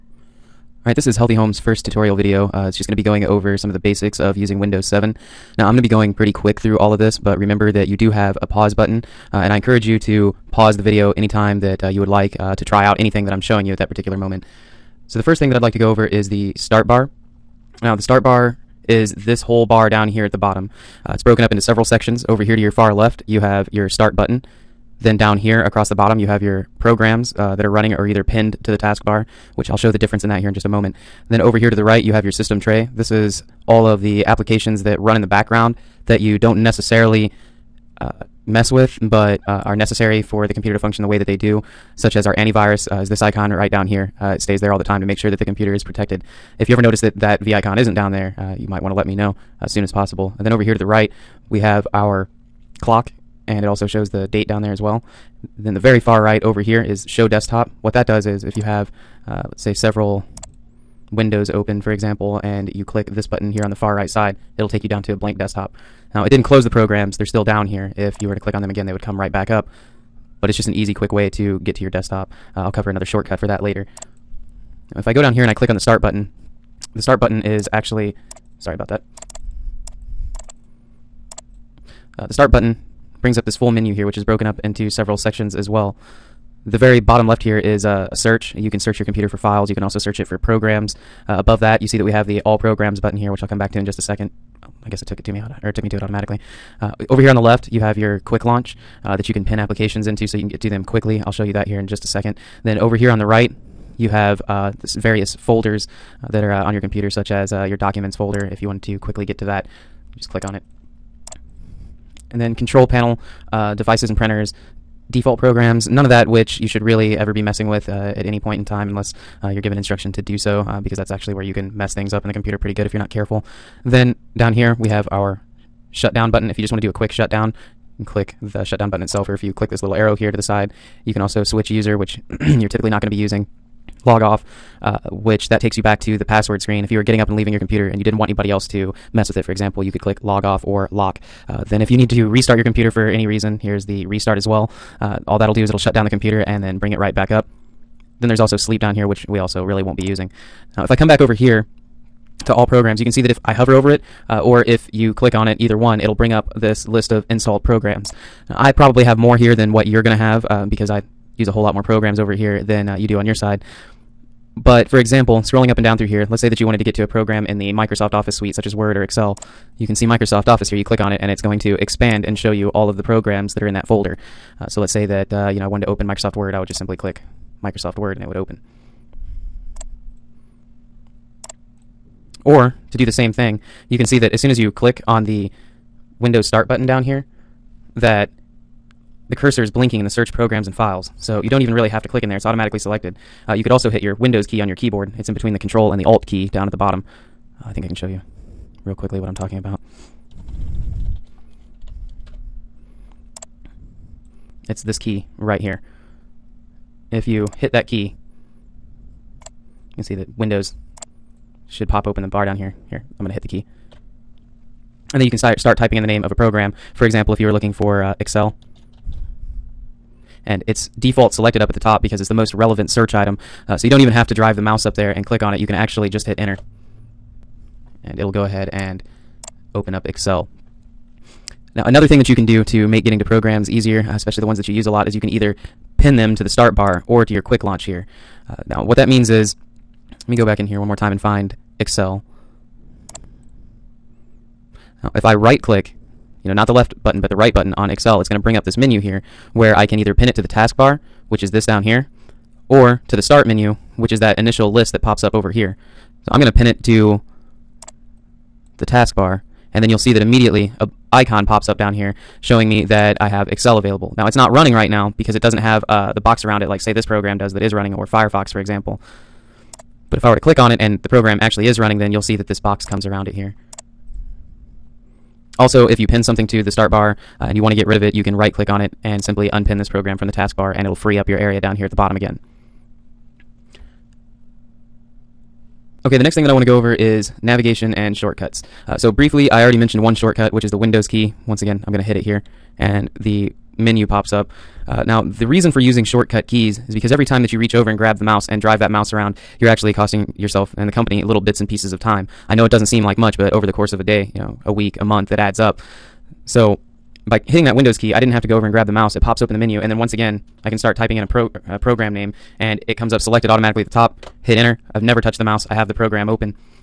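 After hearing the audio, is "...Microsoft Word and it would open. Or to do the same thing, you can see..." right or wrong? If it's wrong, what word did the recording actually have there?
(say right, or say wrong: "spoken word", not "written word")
right.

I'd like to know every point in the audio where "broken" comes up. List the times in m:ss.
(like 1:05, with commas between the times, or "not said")
0:21, 1:24.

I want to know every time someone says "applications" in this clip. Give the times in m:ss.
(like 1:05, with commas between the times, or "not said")
0:34, 1:39.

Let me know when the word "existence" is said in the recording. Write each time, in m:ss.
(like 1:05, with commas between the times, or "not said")
not said.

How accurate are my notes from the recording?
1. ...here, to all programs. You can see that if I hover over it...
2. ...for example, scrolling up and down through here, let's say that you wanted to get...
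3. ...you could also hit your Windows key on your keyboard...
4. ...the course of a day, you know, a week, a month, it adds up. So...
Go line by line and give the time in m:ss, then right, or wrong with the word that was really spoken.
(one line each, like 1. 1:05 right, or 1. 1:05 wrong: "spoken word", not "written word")
1. 2:31 right
2. 2:44 right
3. 3:13 right
4. 5:03 right.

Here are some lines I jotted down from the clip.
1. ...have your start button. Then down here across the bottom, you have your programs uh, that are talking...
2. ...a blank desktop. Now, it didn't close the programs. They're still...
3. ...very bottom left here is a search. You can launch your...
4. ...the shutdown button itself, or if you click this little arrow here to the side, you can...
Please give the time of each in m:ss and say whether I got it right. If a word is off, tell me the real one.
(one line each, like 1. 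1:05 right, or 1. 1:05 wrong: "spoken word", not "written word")
1. 0:23 wrong: "running", not "talking"
2. 1:05 right
3. 1:26 wrong: "search", not "launch"
4. 2:08 right.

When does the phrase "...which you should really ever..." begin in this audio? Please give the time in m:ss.
1:56.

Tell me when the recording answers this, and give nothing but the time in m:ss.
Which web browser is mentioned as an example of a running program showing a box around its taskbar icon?
4:28.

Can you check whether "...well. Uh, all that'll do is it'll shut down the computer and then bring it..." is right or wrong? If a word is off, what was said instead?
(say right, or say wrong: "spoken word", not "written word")
right.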